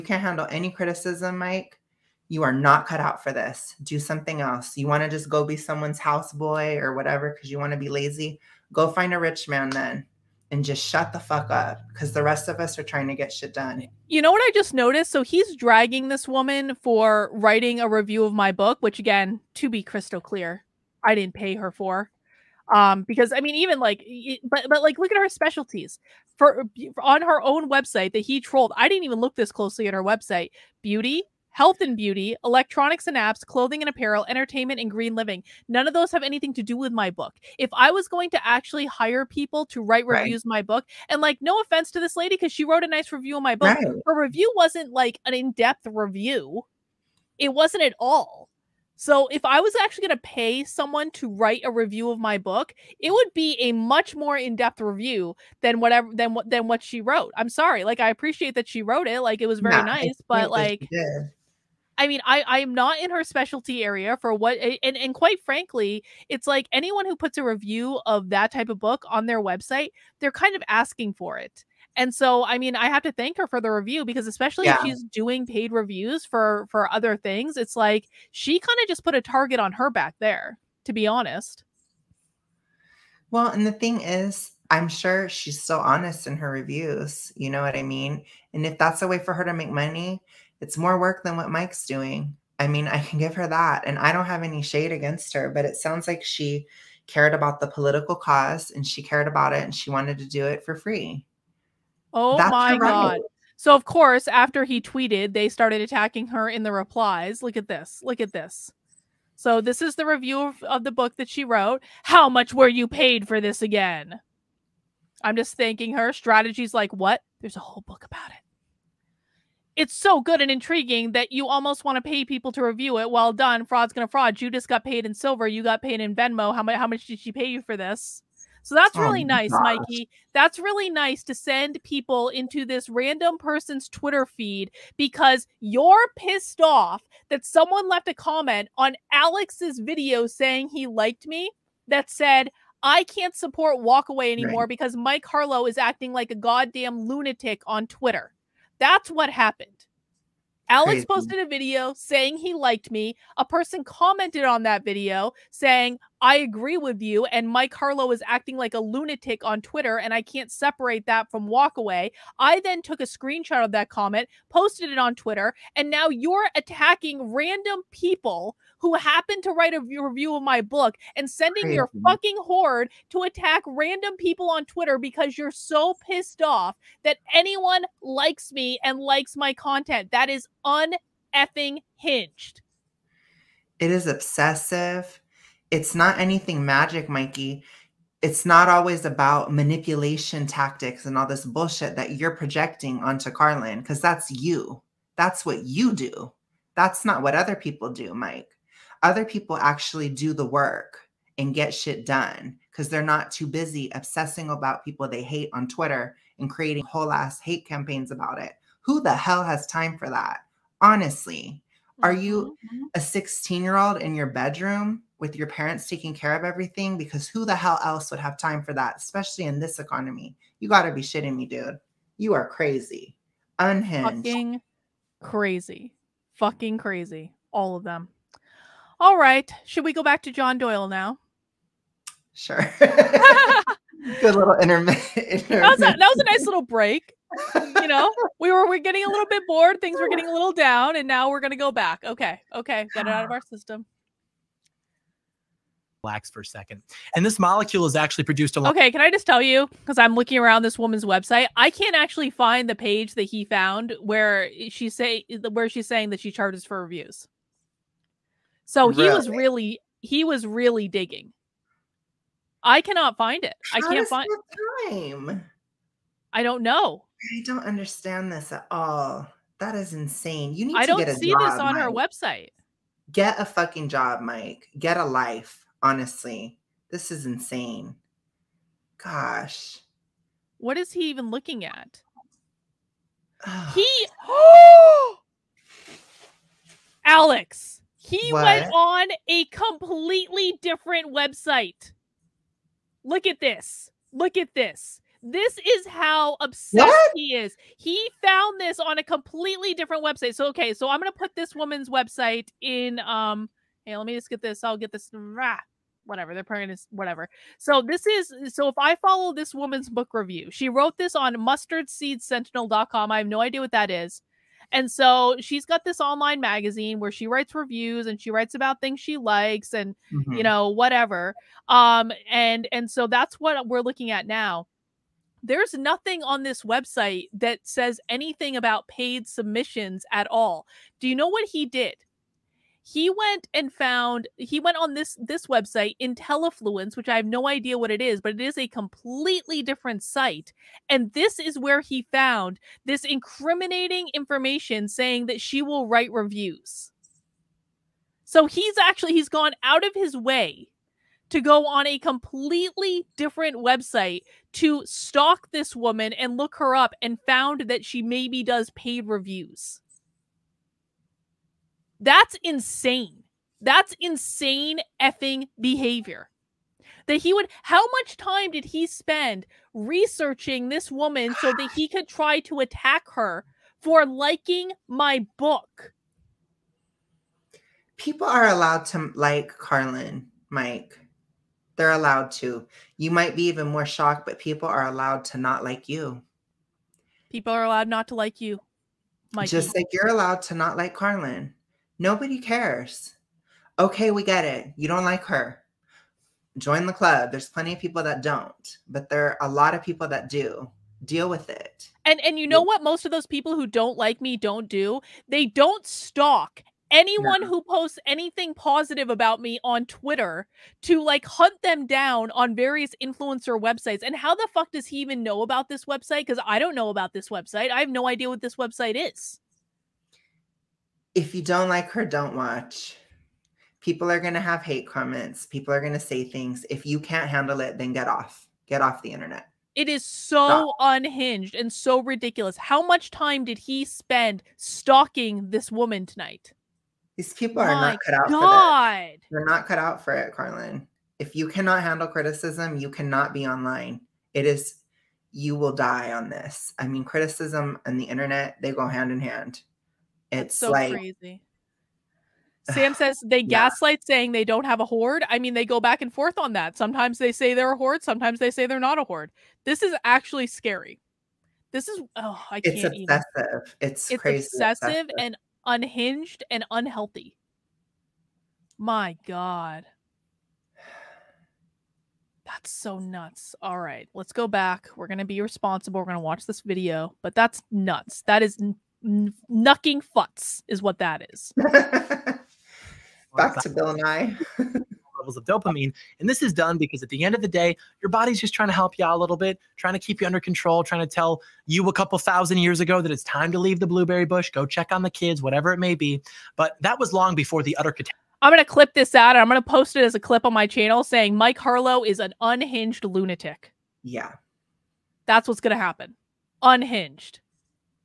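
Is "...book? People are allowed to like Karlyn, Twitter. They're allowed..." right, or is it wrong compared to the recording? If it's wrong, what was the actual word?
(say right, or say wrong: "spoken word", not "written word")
wrong: "Mike", not "Twitter".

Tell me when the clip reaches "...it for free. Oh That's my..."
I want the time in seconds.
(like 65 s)
100 s.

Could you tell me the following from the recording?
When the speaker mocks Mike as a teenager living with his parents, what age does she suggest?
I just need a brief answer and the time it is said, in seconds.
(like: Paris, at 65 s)
16, at 213 s.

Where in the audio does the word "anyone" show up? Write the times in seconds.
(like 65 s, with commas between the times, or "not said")
66 s, 177 s, 406 s.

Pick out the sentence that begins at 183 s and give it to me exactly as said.
It is obsessive it's not anything magic, Mikey.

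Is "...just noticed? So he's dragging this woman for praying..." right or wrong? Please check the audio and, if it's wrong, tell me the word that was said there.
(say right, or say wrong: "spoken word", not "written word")
wrong: "writing", not "praying".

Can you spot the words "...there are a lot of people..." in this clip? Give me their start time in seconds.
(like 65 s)
399 s.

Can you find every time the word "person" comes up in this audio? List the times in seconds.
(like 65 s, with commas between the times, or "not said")
133 s, 153 s.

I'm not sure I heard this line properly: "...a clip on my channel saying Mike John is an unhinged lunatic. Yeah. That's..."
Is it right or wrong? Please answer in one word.
wrong.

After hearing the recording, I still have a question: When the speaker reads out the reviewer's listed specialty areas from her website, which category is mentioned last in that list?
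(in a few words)
green living.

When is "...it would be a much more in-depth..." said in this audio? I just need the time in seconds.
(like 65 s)
52 s.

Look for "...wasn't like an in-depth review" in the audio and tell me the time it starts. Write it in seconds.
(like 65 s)
44 s.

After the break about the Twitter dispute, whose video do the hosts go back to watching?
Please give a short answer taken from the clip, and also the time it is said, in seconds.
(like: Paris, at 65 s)
John Doyle, at 230 s.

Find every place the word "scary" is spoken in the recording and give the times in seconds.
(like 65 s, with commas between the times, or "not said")
460 s.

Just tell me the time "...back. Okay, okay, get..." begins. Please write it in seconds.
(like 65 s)
241 s.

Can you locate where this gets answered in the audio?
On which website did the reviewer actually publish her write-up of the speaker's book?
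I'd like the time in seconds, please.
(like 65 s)
311 s.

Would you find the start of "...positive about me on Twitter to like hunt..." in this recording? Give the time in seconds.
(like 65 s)
408 s.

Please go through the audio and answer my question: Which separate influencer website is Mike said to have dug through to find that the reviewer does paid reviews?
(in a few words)
Intellifluence.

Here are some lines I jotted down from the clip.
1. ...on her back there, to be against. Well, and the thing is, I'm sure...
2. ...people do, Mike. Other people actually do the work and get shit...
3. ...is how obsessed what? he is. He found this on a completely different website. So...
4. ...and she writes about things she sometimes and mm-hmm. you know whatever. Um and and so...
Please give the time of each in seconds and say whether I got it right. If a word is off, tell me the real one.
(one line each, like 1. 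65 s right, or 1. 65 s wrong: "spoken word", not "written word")
1. 79 s wrong: "honest", not "against"
2. 197 s right
3. 295 s right
4. 318 s wrong: "likes", not "sometimes".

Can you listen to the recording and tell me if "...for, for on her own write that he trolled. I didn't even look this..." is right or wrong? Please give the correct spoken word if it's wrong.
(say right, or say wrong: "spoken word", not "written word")
wrong: "website", not "write".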